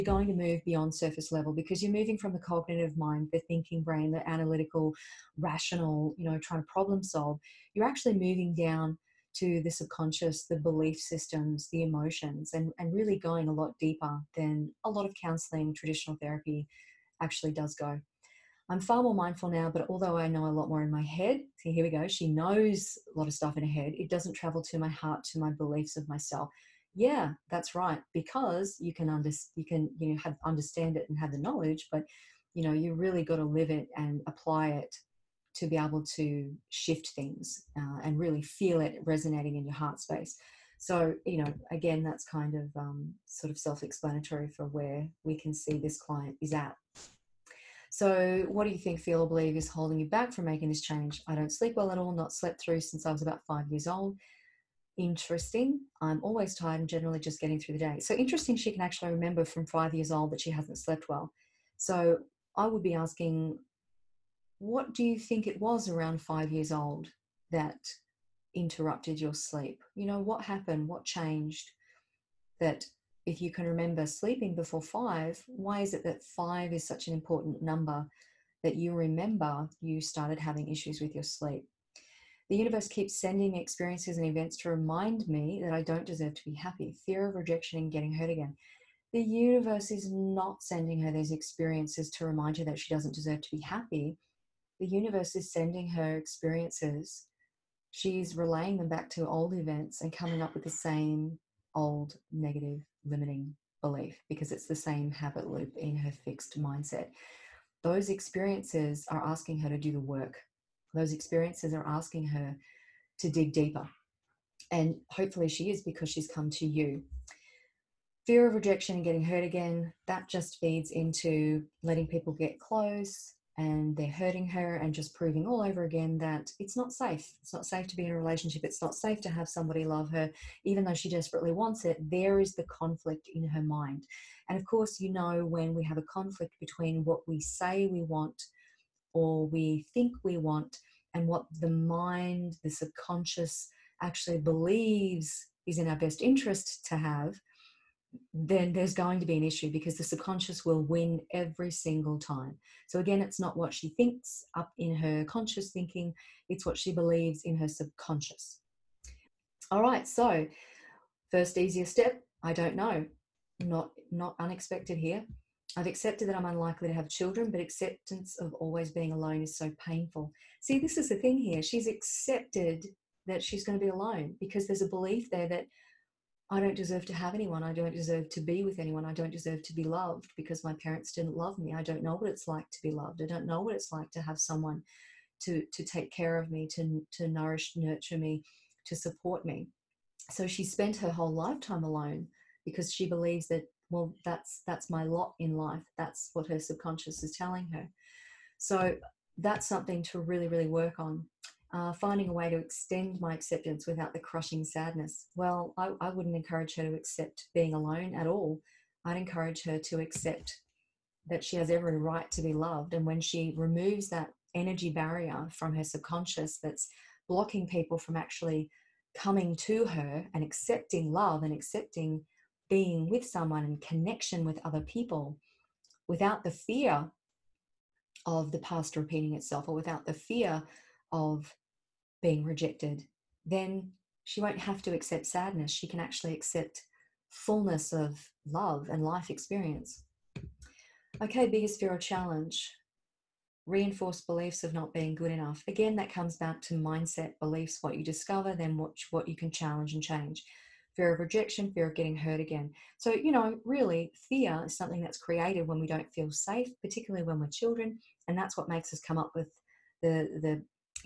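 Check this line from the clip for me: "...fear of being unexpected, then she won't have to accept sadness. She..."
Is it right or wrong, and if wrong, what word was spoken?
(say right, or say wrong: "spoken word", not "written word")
wrong: "rejected", not "unexpected".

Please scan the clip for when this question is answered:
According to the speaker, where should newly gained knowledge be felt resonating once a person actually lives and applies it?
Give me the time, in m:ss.
0:39.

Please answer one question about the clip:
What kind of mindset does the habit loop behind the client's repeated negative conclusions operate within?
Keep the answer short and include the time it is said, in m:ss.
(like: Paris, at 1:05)
fixed mindset, at 1:46.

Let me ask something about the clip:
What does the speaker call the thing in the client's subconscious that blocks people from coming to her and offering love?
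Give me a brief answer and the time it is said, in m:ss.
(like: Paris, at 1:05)
energy barrier, at 3:34.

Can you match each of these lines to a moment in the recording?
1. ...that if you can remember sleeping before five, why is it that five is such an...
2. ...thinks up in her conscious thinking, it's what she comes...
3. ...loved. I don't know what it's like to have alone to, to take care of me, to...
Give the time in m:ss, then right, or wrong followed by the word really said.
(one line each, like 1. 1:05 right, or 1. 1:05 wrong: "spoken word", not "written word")
1. 1:12 right
2. 2:33 wrong: "believes", not "comes"
3. 3:02 wrong: "someone", not "alone".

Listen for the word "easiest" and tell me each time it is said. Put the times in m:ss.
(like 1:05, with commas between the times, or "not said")
2:41.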